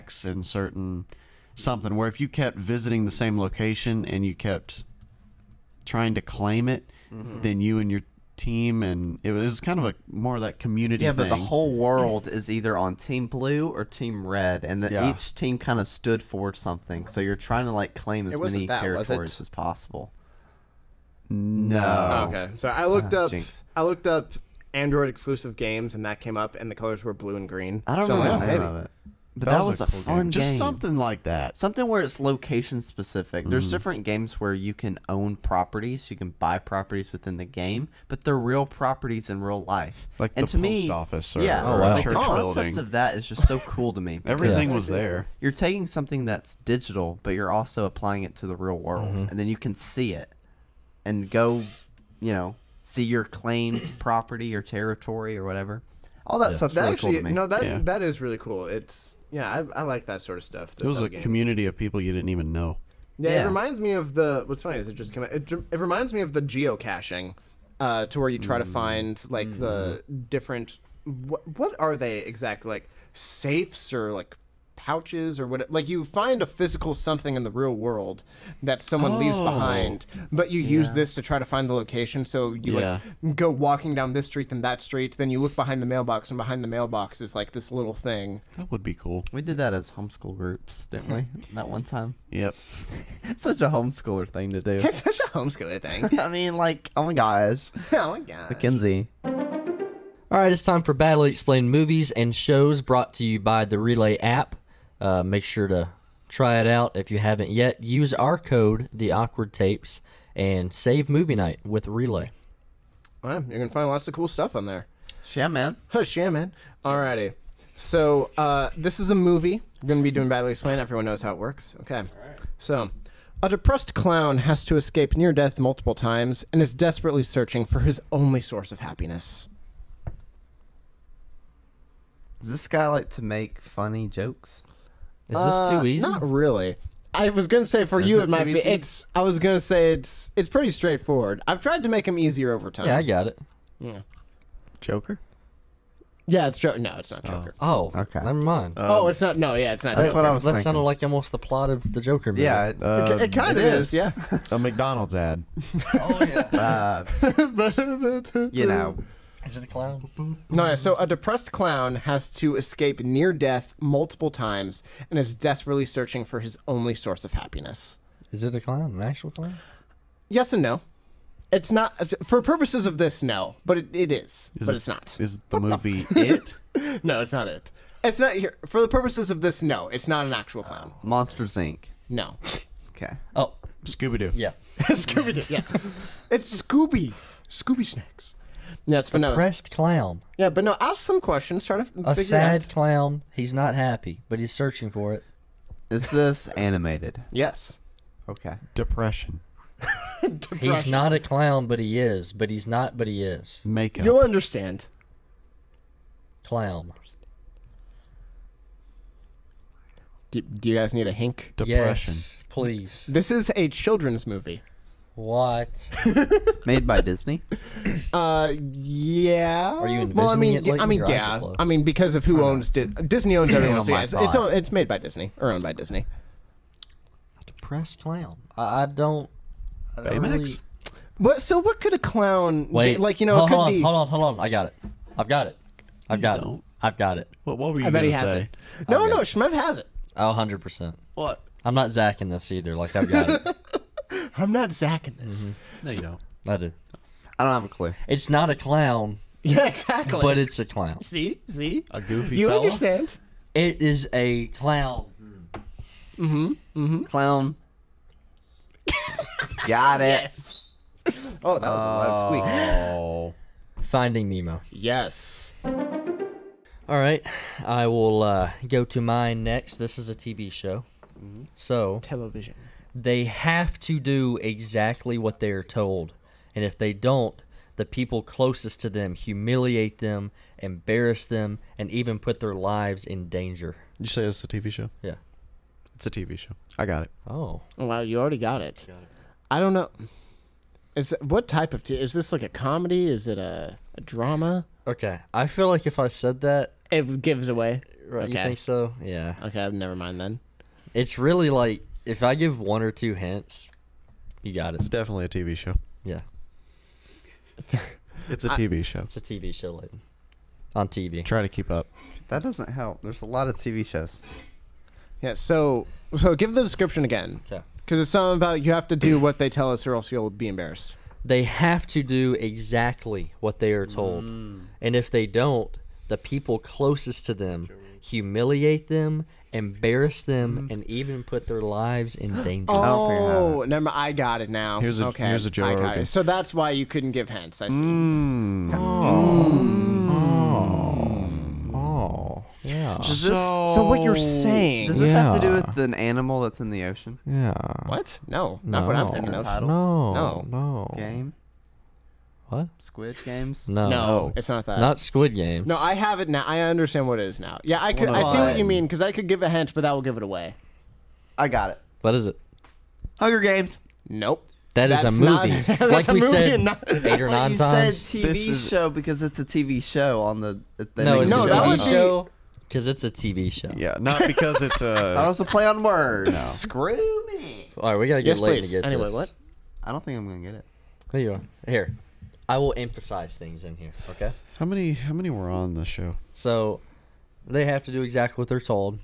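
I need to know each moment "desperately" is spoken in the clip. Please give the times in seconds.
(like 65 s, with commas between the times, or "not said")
126 s, 165 s.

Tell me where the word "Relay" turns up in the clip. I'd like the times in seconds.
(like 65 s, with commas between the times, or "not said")
103 s, 111 s.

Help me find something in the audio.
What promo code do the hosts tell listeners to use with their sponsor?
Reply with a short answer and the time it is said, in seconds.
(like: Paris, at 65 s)
the awkward tapes, at 108 s.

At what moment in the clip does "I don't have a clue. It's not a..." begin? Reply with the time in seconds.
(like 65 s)
247 s.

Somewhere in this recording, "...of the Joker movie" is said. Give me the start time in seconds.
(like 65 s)
151 s.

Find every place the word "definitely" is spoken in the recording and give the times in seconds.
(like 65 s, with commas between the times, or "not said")
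304 s.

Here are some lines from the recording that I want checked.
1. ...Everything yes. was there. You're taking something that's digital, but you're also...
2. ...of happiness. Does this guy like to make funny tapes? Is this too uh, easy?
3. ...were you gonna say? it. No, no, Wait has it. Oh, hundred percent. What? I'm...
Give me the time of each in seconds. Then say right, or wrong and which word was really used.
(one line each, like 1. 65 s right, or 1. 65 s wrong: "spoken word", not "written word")
1. 44 s right
2. 128 s wrong: "jokes", not "tapes"
3. 237 s wrong: "Shmev", not "Wait".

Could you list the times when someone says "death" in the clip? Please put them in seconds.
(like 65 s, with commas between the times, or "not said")
125 s, 163 s.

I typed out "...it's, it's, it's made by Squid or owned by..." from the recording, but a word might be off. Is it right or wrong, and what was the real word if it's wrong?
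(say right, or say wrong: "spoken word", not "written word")
wrong: "Disney", not "Squid".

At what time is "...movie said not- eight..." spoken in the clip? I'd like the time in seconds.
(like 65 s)
366 s.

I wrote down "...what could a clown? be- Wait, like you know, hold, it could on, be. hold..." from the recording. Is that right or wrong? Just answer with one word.
right.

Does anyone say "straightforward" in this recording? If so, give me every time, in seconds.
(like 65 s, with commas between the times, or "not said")
140 s.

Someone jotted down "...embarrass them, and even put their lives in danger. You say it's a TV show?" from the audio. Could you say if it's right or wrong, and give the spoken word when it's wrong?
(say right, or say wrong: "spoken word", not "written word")
right.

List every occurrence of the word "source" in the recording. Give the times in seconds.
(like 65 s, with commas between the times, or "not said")
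128 s, 166 s.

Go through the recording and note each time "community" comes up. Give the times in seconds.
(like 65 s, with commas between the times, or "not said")
10 s, 61 s.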